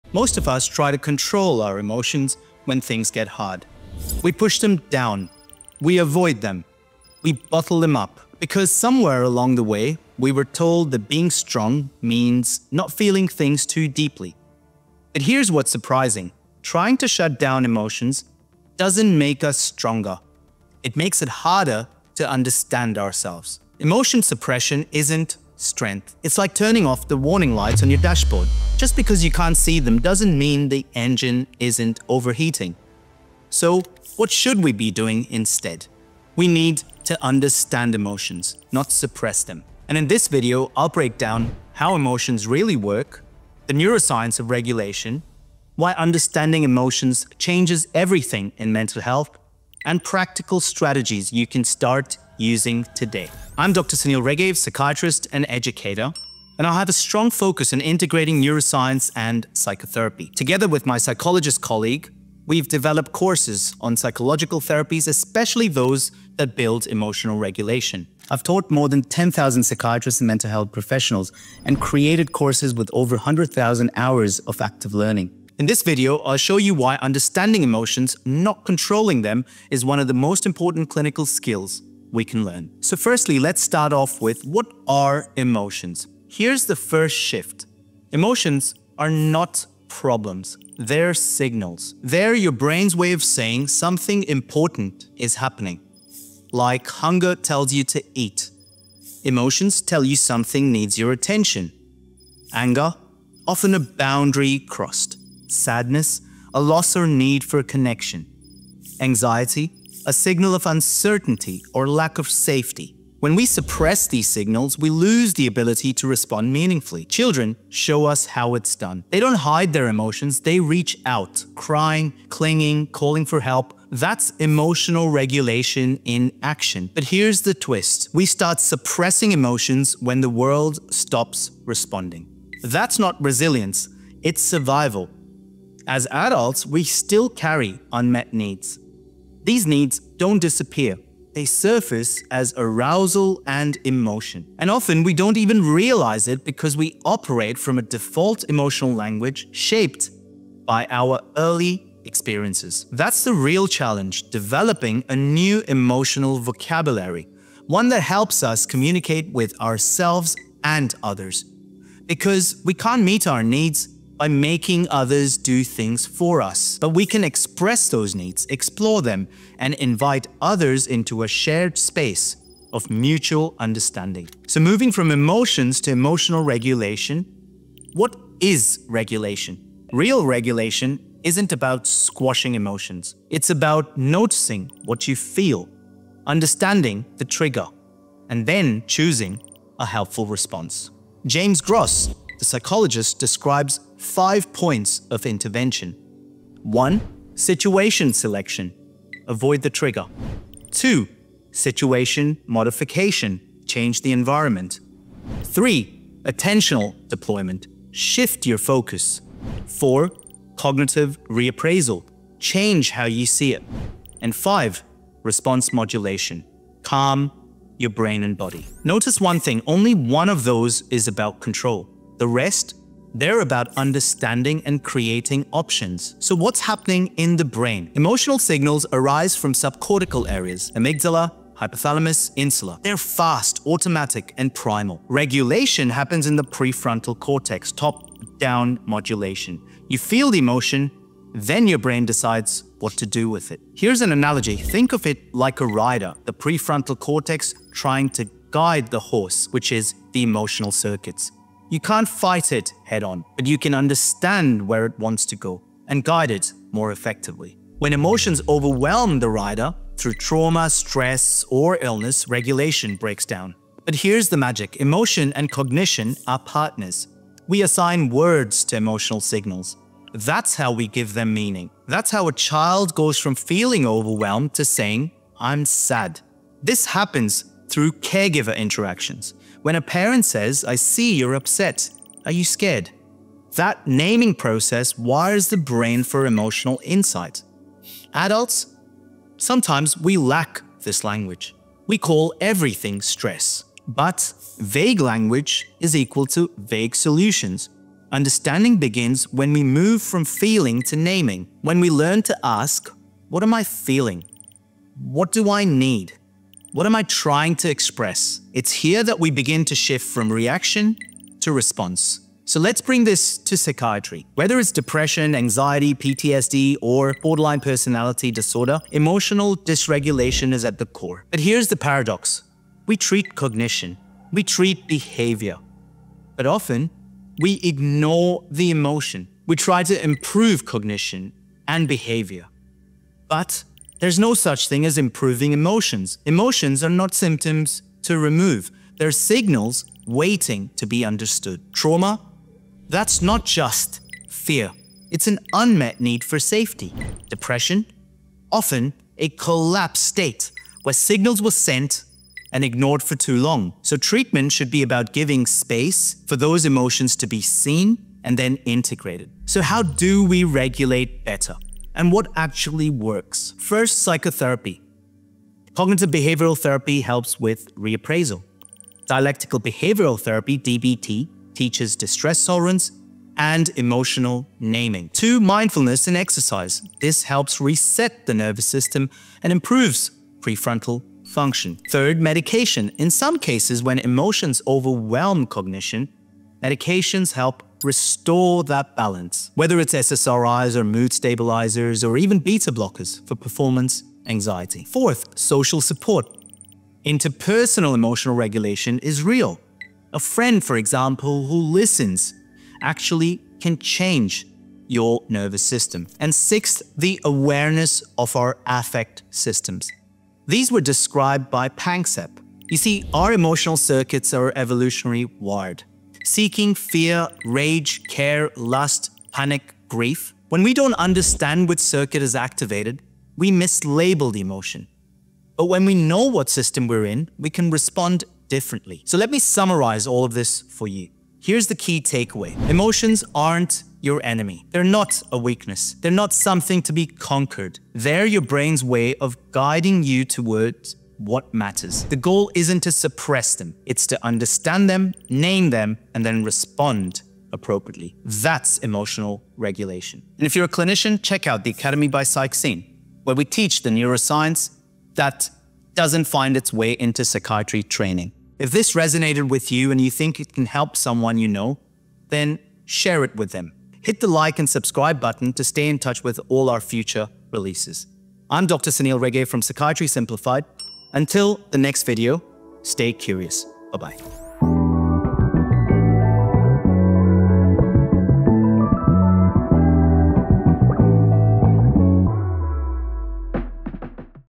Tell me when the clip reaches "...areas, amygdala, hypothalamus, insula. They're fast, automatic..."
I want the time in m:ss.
3:50.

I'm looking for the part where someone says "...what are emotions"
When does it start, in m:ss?
1:24.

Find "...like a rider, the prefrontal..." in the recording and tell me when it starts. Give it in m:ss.
4:05.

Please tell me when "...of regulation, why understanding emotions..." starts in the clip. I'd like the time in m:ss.
0:44.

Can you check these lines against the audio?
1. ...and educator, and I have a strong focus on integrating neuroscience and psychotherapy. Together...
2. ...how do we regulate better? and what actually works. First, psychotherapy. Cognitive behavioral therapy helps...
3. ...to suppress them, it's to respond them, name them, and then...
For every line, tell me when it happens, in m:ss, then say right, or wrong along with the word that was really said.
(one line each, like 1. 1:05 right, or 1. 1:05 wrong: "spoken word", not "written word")
1. 0:55 right
2. 5:59 right
3. 7:22 wrong: "understand", not "respond".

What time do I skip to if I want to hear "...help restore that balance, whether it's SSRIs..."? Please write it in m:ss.
6:27.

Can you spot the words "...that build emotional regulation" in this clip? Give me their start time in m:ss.
1:06.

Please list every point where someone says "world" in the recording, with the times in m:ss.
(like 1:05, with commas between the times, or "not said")
2:10.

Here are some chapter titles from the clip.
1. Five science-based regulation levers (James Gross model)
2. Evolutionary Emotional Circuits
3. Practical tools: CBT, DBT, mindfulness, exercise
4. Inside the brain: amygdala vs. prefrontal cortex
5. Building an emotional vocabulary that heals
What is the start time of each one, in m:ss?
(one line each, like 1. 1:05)
1. 3:12
2. 6:52
3. 5:59
4. 3:47
5. 4:24.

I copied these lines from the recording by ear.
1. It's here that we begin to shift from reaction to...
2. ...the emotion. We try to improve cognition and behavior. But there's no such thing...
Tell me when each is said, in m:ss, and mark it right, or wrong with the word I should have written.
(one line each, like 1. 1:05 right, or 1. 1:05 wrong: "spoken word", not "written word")
1. 5:08 right
2. 5:28 right.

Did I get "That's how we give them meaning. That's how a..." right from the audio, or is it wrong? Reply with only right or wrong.
right.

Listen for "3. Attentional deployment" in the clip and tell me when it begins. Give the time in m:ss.
3:25.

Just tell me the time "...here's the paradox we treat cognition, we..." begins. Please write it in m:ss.
5:21.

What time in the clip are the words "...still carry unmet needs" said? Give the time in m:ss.
2:16.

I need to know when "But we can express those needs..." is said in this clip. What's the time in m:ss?
2:46.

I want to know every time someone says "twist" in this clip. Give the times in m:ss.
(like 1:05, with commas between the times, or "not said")
2:07.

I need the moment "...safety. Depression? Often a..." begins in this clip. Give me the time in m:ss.
5:46.